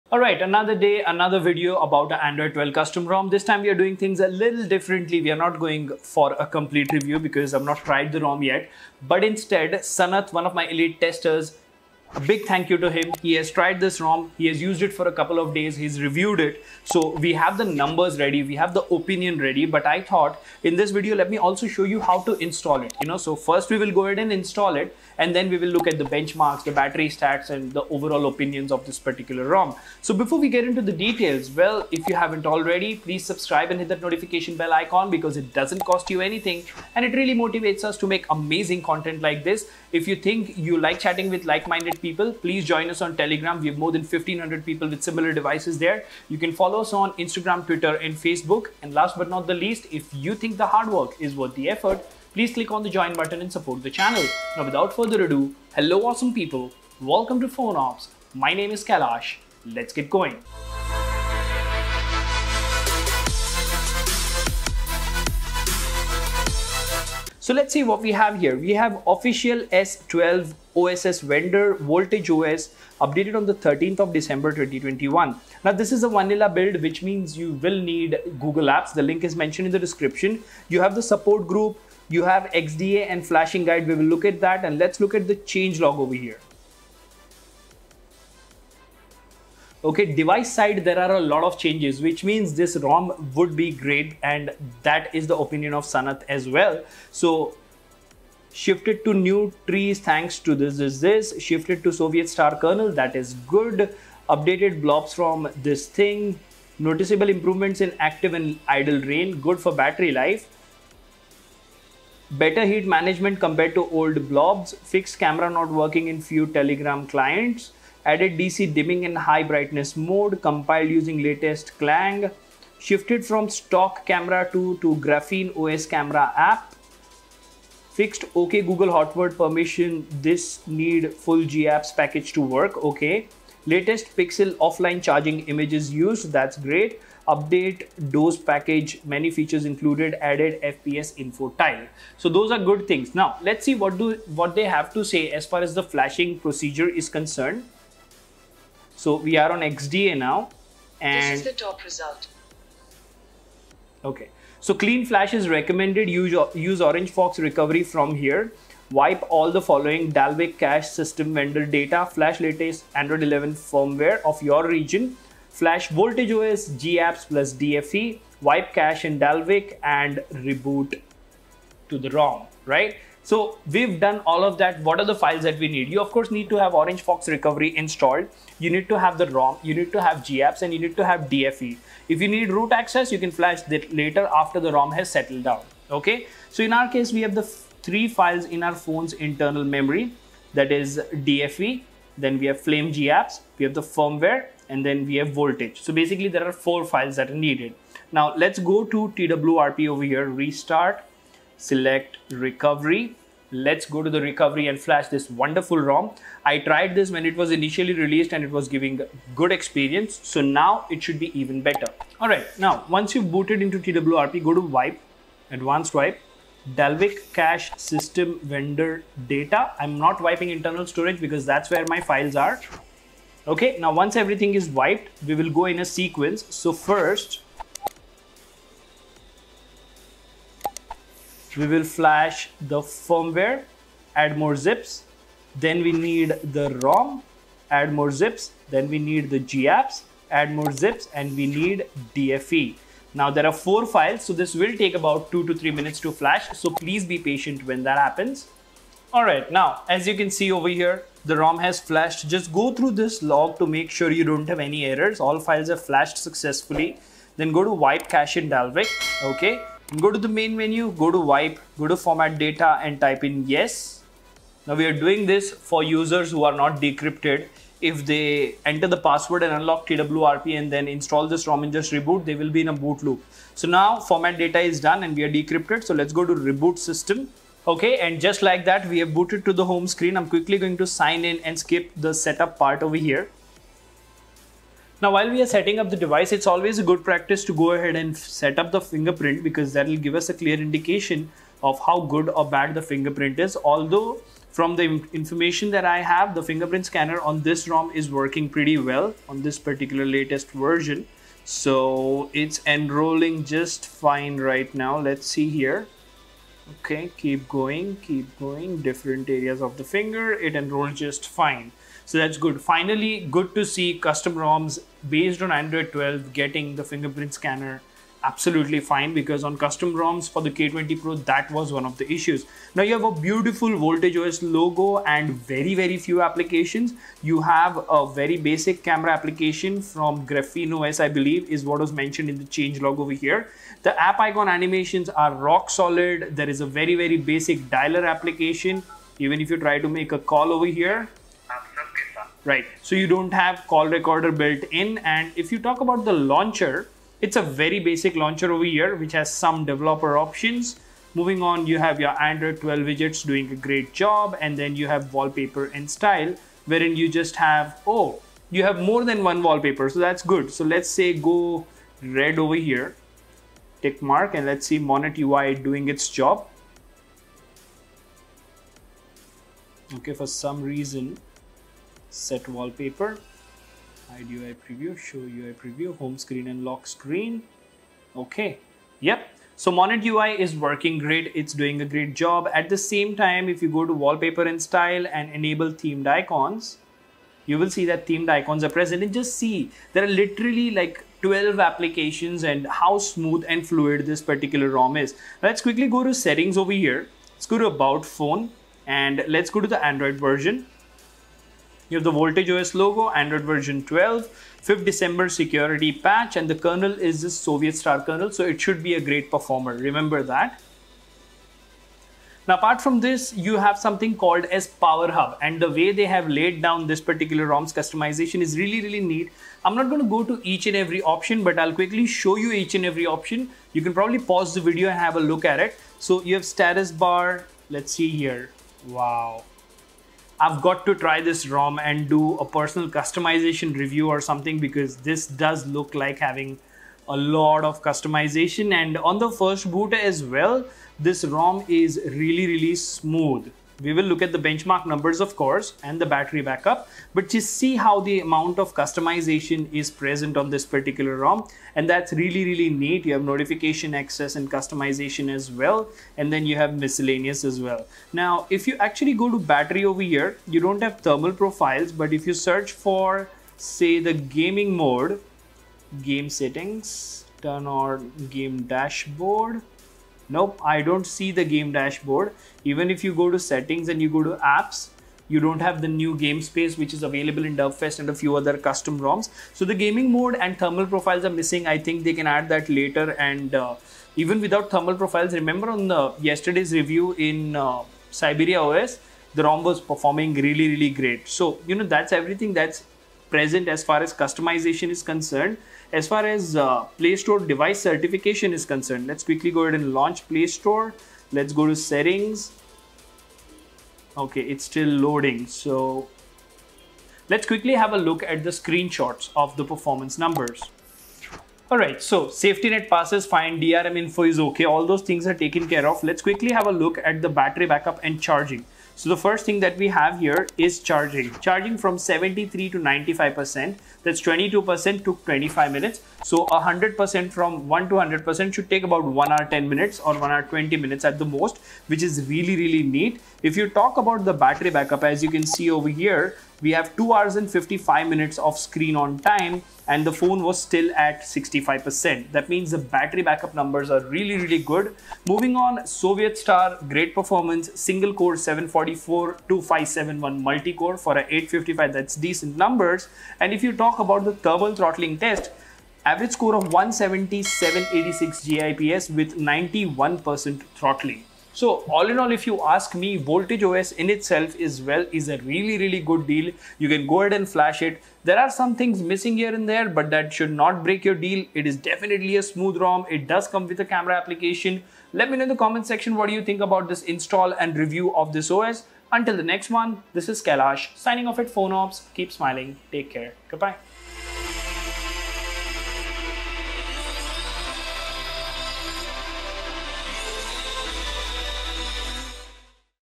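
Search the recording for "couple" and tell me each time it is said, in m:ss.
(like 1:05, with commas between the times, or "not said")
0:15.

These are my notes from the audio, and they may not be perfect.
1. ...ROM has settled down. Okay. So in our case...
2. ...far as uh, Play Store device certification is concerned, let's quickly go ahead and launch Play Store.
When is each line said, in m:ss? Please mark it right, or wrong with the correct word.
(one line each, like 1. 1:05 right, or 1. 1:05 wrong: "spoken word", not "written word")
1. 3:04 right
2. 8:16 right.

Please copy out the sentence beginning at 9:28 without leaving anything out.
There are some things missing here and there, but that should not break your deal.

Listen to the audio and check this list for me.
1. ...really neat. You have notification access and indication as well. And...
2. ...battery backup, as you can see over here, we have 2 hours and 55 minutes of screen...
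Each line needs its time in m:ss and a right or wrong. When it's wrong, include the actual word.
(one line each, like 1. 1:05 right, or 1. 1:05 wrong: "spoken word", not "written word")
1. 7:32 wrong: "customization", not "indication"
2. 8:54 right.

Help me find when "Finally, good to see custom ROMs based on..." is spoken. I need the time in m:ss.
5:12.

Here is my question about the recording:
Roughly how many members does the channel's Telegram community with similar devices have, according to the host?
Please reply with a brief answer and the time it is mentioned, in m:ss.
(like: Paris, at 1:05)
1500, at 0:44.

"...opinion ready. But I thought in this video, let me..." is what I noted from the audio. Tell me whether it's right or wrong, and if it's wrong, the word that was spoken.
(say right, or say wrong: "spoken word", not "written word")
right.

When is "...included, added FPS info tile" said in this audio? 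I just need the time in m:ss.
2:19.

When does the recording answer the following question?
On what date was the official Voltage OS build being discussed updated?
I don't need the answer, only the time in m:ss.
1:13.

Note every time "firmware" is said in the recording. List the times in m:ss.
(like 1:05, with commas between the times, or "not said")
2:43, 3:13, 3:52.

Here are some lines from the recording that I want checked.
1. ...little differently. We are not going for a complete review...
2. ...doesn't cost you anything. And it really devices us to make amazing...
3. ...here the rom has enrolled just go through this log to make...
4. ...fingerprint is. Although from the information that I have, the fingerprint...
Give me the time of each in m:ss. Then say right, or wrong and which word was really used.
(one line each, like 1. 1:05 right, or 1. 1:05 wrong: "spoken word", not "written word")
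1. 0:04 right
2. 0:35 wrong: "motivates", not "devices"
3. 4:10 wrong: "flashed", not "enrolled"
4. 4:52 right.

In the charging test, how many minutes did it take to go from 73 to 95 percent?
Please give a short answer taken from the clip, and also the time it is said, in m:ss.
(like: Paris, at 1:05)
25 minutes, at 8:45.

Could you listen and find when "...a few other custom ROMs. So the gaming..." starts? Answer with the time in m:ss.
7:58.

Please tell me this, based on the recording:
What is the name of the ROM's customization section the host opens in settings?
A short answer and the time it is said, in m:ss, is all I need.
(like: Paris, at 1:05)
Power Hub, at 6:54.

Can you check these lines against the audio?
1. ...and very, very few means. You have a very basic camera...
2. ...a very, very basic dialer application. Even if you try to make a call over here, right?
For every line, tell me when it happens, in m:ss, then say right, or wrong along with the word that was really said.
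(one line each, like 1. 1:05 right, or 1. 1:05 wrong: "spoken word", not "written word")
1. 5:25 wrong: "applications", not "means"
2. 5:36 right.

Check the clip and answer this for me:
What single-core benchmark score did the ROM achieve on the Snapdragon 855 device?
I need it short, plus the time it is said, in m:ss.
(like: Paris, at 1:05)
744, at 9:08.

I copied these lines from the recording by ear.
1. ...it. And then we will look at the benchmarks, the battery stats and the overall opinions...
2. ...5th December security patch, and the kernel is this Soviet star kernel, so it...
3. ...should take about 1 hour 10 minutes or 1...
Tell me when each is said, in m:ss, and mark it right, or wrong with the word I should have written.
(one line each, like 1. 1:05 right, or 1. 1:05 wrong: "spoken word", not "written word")
1. 0:24 right
2. 6:44 right
3. 8:48 right.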